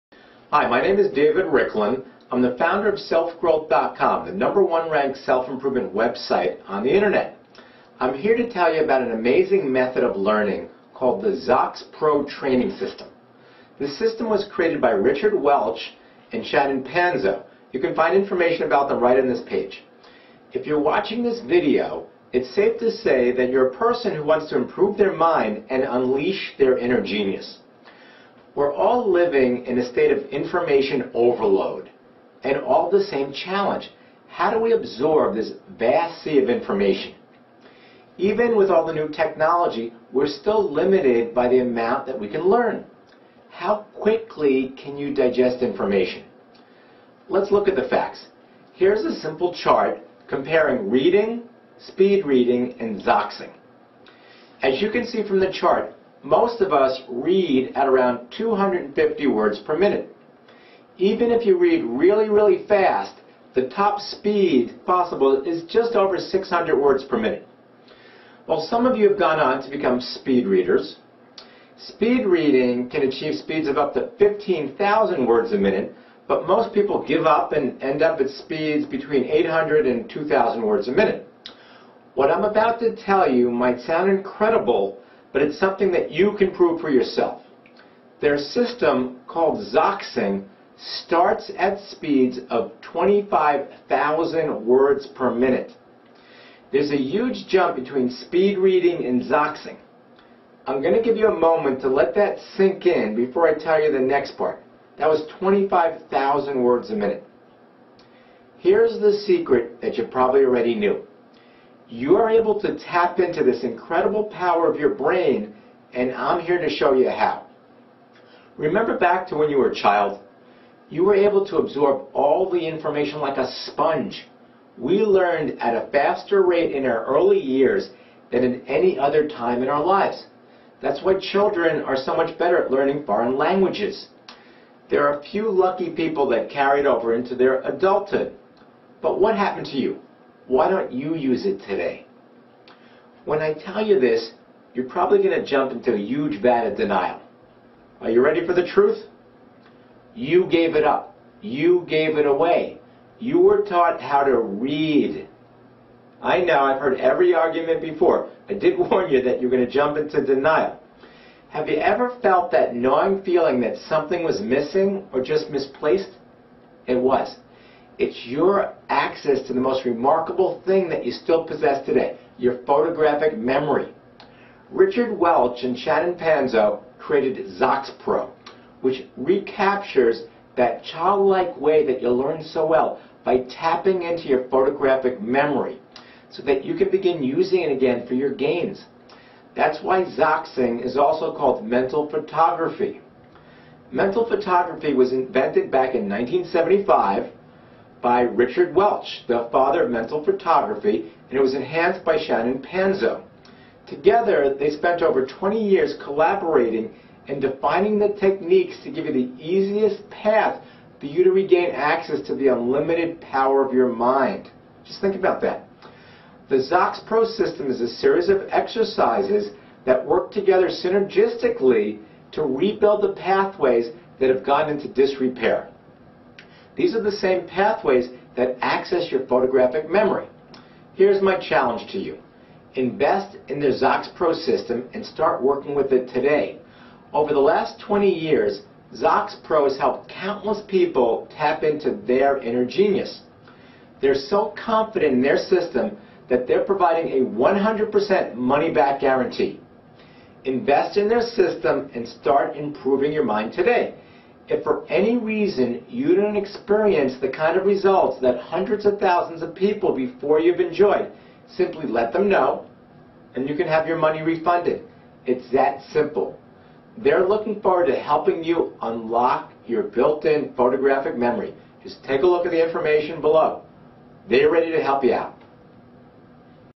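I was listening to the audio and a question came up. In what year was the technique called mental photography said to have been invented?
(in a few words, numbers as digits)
1975.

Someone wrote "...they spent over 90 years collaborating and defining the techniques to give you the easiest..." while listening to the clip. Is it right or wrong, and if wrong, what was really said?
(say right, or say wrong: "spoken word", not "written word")
wrong: "20", not "90".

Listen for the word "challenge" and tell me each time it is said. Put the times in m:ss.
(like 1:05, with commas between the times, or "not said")
0:33, 3:51.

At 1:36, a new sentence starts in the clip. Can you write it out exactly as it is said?
There's a huge jump between speed reading and Zoxing.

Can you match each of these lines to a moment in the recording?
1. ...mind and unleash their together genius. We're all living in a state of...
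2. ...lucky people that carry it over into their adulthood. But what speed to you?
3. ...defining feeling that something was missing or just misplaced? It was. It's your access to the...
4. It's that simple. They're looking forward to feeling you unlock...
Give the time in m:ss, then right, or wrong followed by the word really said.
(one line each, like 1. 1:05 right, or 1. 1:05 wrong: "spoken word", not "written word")
1. 0:25 wrong: "inner", not "together"
2. 2:15 wrong: "happened", not "speed"
3. 2:42 wrong: "gnawing", not "defining"
4. 4:25 wrong: "helping", not "feeling".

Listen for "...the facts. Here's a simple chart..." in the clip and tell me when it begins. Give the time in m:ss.
0:47.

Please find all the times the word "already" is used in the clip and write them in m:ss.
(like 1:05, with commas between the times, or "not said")
1:50.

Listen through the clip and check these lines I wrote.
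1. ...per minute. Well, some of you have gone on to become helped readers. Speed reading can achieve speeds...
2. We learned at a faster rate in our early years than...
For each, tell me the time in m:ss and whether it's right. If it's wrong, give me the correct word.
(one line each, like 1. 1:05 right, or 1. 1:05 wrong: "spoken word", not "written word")
1. 1:07 wrong: "speed", not "helped"
2. 2:04 right.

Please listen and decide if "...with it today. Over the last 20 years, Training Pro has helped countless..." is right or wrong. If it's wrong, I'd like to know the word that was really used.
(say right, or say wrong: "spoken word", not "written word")
wrong: "Zox", not "Training".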